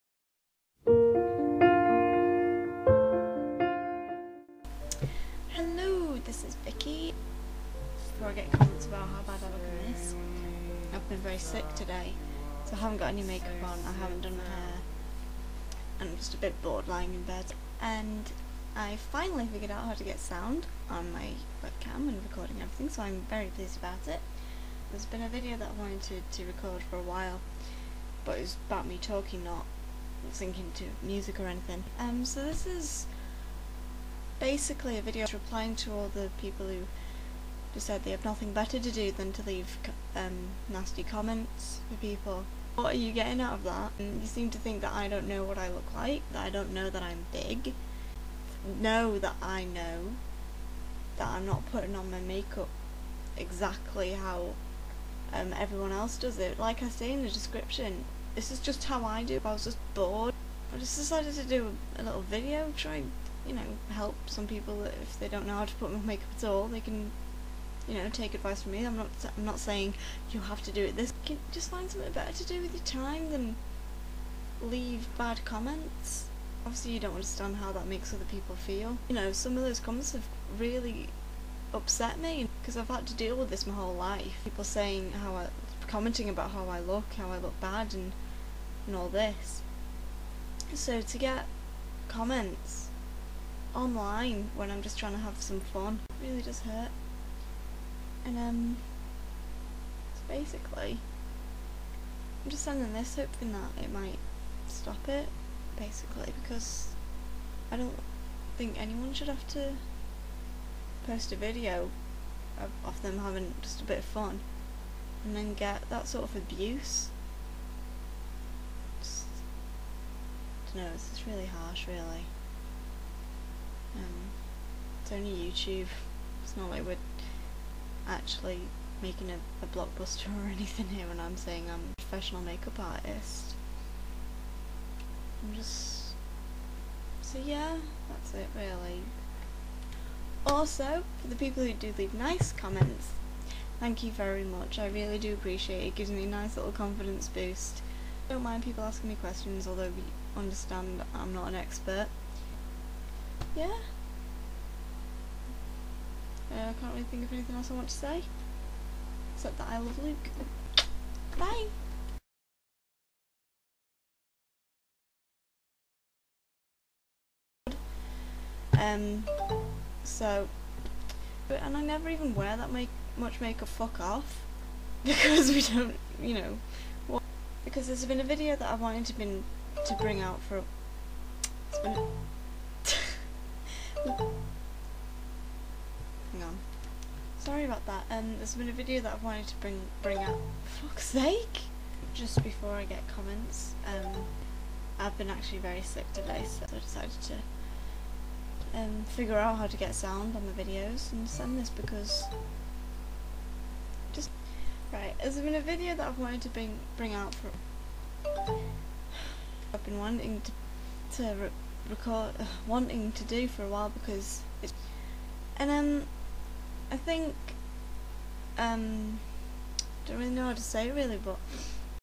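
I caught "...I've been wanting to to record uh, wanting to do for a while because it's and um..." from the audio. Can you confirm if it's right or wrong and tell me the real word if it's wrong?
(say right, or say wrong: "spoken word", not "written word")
right.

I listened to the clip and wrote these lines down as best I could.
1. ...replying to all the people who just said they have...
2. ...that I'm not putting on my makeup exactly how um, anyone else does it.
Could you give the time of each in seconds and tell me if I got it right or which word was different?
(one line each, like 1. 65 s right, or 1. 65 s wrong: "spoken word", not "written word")
1. 35 s right
2. 51 s wrong: "everyone", not "anyone".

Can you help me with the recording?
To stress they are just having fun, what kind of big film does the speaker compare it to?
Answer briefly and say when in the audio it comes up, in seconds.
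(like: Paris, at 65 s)
a blockbuster, at 129 s.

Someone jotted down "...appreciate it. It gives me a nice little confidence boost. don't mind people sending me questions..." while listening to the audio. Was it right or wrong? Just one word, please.
wrong.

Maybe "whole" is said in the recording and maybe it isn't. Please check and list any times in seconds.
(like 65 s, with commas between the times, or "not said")
83 s.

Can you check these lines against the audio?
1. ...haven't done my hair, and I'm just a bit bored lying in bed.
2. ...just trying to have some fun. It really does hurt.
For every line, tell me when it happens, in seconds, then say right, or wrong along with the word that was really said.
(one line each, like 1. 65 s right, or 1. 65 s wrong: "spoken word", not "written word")
1. 14 s right
2. 94 s right.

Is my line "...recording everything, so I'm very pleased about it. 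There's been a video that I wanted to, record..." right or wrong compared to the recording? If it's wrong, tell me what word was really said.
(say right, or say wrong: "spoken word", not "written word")
right.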